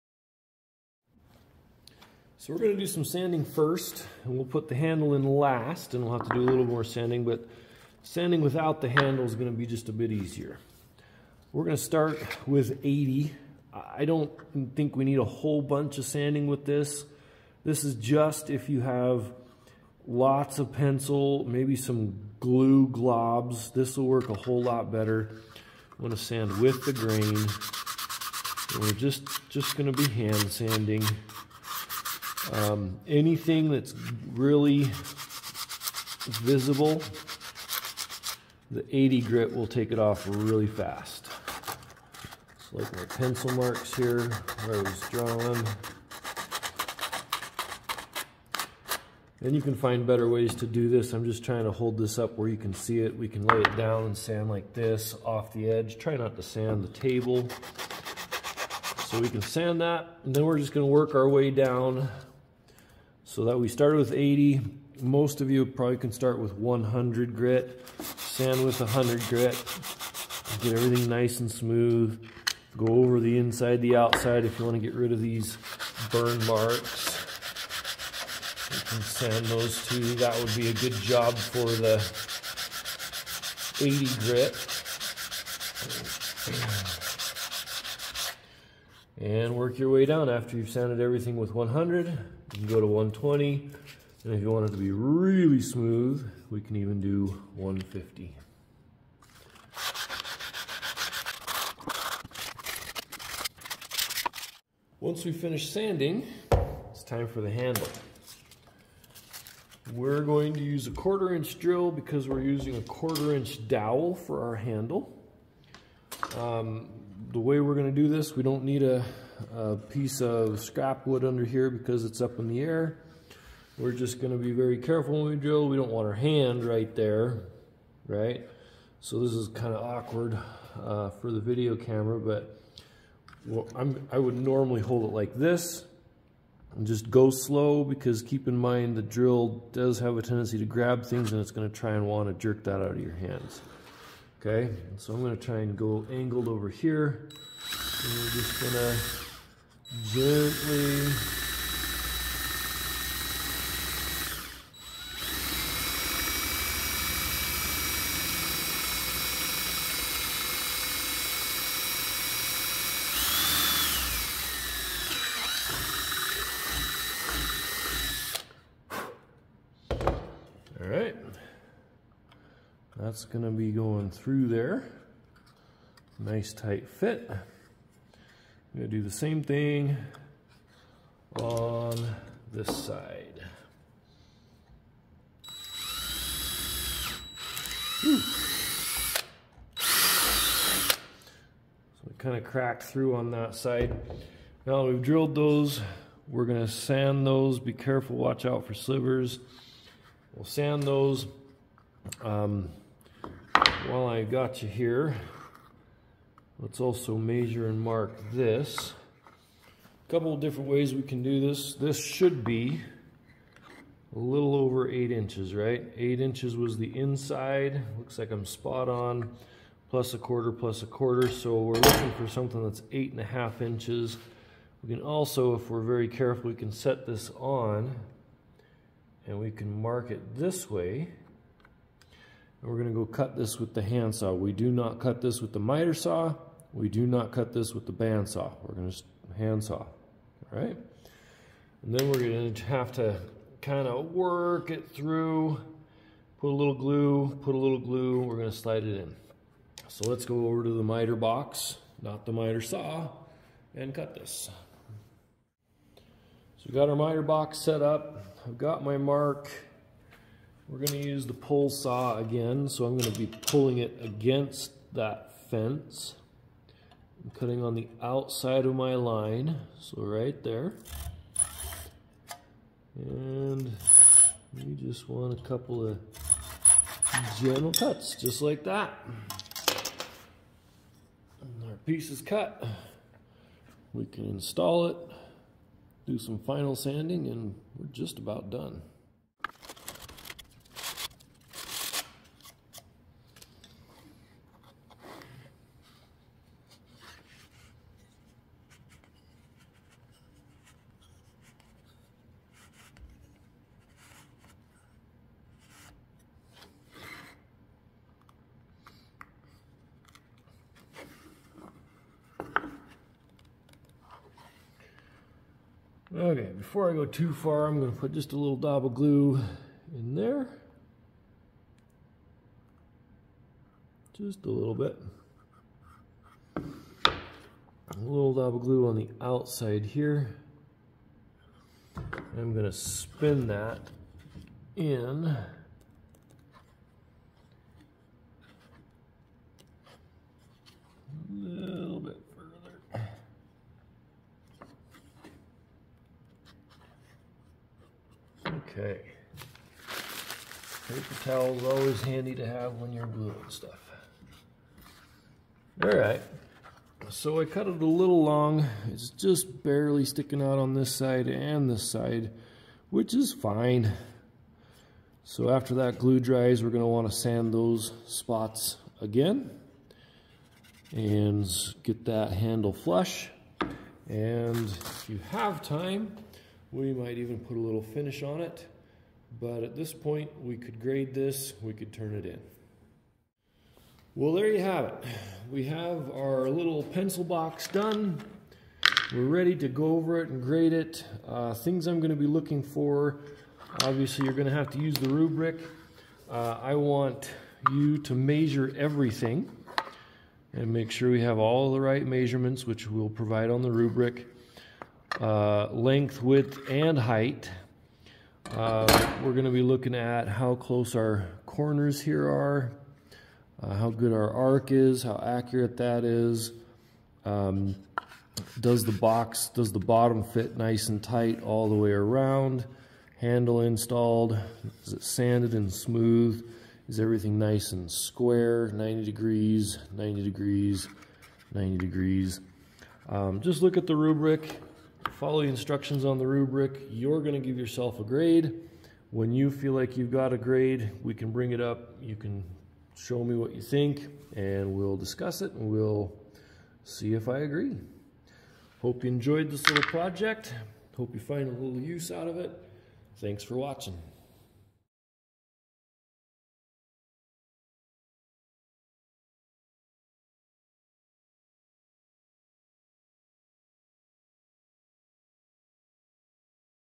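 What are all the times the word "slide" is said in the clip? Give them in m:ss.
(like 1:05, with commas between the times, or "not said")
4:08.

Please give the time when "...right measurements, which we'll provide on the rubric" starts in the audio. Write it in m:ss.
6:41.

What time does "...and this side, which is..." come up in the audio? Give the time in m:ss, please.
6:01.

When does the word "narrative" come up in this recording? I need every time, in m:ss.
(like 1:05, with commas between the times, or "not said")
not said.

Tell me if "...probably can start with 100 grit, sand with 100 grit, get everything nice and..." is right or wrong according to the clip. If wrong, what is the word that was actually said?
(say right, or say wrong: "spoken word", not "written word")
right.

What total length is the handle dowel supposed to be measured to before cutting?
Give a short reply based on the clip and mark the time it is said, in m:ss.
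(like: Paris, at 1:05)
8 and a half inches, at 3:42.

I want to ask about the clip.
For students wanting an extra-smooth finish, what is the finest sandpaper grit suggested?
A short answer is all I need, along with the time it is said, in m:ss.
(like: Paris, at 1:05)
150, at 1:36.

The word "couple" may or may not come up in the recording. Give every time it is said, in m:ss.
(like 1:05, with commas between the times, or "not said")
3:30, 4:35.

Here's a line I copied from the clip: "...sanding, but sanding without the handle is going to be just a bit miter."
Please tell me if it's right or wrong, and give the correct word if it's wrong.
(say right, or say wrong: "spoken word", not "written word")
wrong: "easier", not "miter".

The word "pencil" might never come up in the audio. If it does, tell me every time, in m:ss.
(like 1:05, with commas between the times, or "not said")
0:20, 0:43, 6:26.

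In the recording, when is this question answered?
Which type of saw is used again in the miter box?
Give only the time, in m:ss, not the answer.
4:21.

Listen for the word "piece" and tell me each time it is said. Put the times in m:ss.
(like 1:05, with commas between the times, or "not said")
1:59, 4:41.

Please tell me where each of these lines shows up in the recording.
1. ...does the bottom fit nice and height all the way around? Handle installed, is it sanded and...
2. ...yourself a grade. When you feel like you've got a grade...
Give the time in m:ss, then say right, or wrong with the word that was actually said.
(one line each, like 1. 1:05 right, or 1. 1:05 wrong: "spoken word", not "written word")
1. 6:59 wrong: "tight", not "height"
2. 7:17 right.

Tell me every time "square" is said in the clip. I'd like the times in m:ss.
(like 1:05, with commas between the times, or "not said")
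7:07.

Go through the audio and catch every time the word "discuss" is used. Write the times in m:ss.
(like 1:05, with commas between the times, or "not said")
7:24.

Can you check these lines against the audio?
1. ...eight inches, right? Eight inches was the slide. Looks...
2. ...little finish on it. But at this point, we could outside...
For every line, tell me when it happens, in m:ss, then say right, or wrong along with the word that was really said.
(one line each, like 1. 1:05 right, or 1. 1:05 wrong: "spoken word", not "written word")
1. 3:34 wrong: "inside", not "slide"
2. 6:17 wrong: "grade", not "outside".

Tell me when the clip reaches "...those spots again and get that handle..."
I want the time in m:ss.
6:07.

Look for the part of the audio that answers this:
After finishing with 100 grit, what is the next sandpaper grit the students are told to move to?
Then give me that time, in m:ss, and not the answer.
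1:32.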